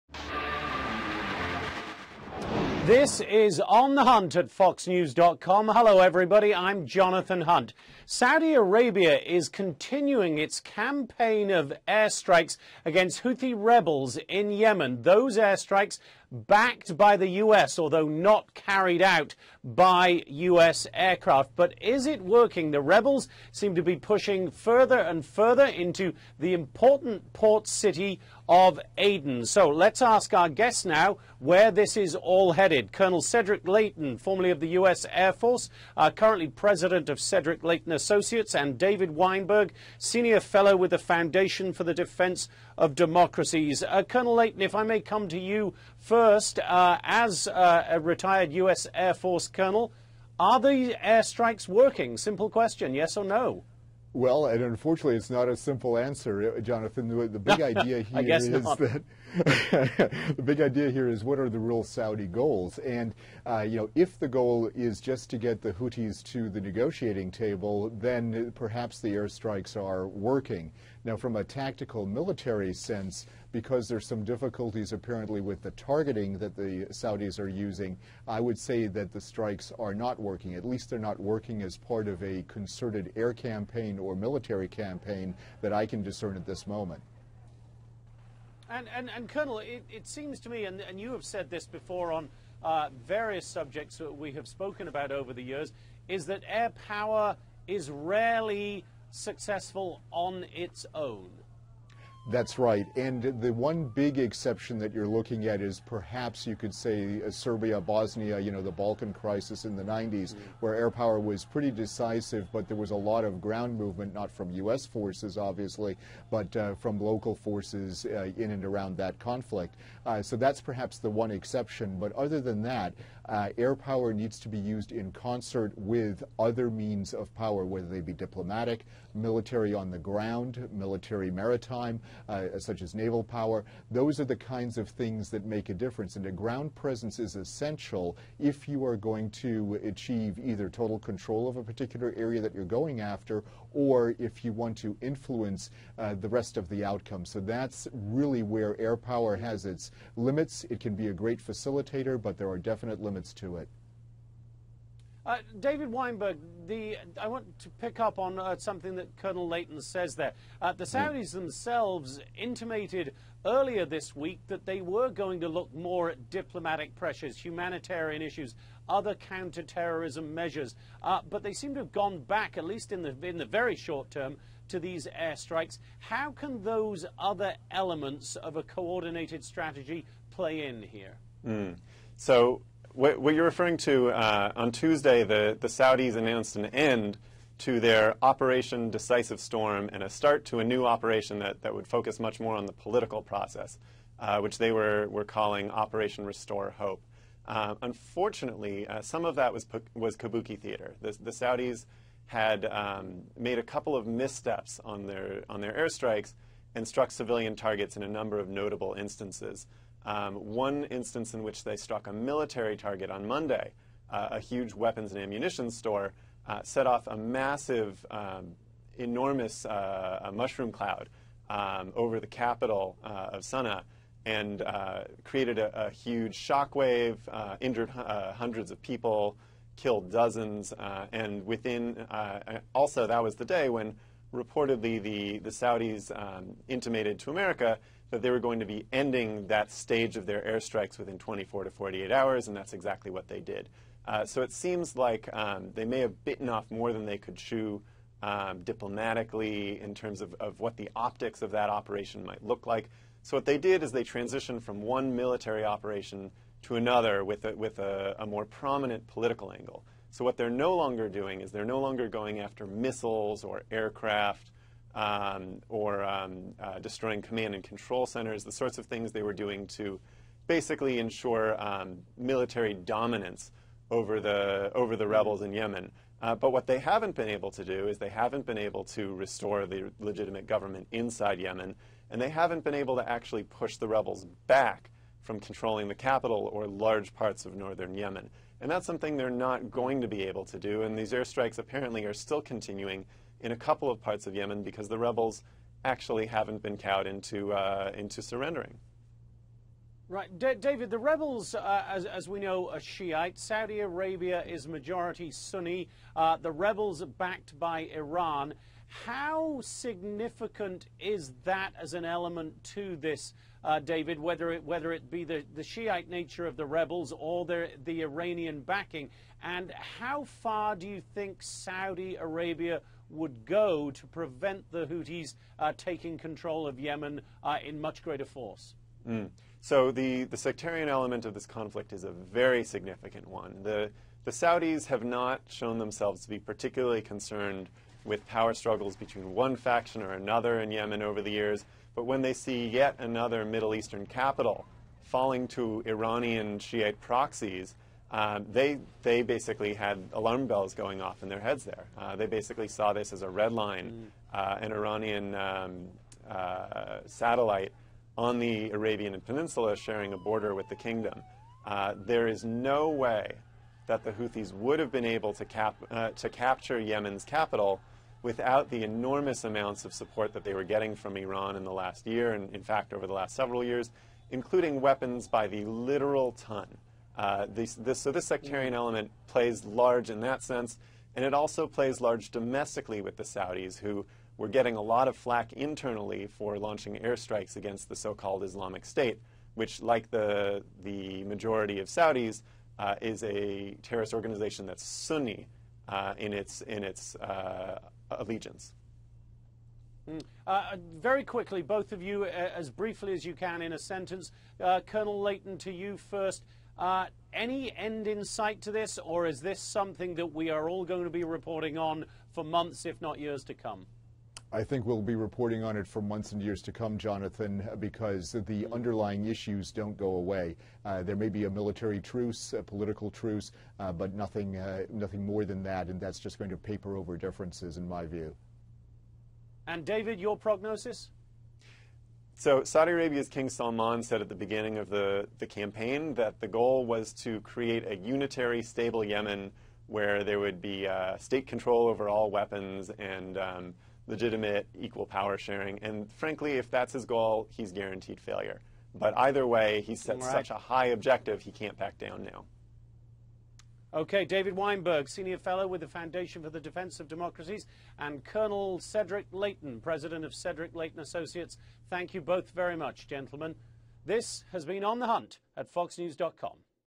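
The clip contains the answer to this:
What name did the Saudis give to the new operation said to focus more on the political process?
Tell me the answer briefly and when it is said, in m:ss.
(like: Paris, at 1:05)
Operation Restore Hope, at 3:15.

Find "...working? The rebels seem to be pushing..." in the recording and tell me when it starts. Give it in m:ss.
0:22.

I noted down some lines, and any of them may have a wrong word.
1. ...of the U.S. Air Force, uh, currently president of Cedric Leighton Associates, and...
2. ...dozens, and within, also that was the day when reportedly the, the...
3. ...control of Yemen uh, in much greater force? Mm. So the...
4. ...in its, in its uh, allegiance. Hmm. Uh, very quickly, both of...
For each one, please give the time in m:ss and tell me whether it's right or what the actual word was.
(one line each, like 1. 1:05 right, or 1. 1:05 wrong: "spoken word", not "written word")
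1. 0:34 right
2. 3:50 right
3. 5:26 right
4. 6:36 right.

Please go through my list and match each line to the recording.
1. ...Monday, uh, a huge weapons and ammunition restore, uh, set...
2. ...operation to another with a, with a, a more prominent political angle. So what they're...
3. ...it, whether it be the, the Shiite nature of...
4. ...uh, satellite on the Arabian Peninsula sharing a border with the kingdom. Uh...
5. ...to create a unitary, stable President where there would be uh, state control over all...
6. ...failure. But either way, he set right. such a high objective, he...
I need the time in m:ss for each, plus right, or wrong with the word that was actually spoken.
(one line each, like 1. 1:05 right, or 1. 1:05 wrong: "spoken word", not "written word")
1. 3:33 wrong: "store", not "restore"
2. 4:15 right
3. 5:14 right
4. 5:56 right
5. 7:17 wrong: "Yemen", not "President"
6. 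7:28 right.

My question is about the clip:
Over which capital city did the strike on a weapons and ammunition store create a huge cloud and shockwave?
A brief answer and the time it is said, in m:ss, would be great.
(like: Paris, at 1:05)
Sana'a, at 3:43.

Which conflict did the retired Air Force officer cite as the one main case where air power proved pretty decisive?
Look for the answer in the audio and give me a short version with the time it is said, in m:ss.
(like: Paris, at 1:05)
The Balkan crisis in the 90s, at 1:48.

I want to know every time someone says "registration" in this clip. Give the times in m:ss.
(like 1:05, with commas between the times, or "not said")
not said.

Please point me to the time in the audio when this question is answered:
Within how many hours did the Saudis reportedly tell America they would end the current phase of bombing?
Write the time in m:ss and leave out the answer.
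4:01.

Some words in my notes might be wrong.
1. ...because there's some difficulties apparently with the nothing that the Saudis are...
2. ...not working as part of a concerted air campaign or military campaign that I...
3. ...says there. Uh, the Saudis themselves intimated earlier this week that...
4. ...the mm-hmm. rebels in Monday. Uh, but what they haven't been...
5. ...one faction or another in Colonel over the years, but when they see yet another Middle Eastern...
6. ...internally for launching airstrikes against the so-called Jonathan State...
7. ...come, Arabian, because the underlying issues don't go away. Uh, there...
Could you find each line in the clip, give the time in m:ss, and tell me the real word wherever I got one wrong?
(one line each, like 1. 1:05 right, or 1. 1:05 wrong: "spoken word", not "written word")
1. 1:13 wrong: "targeting", not "nothing"
2. 1:20 right
3. 2:39 right
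4. 4:34 wrong: "Yemen", not "Monday"
5. 5:39 wrong: "Yemen", not "Colonel"
6. 6:25 wrong: "Islamic", not "Jonathan"
7. 6:56 wrong: "Jonathan", not "Arabian".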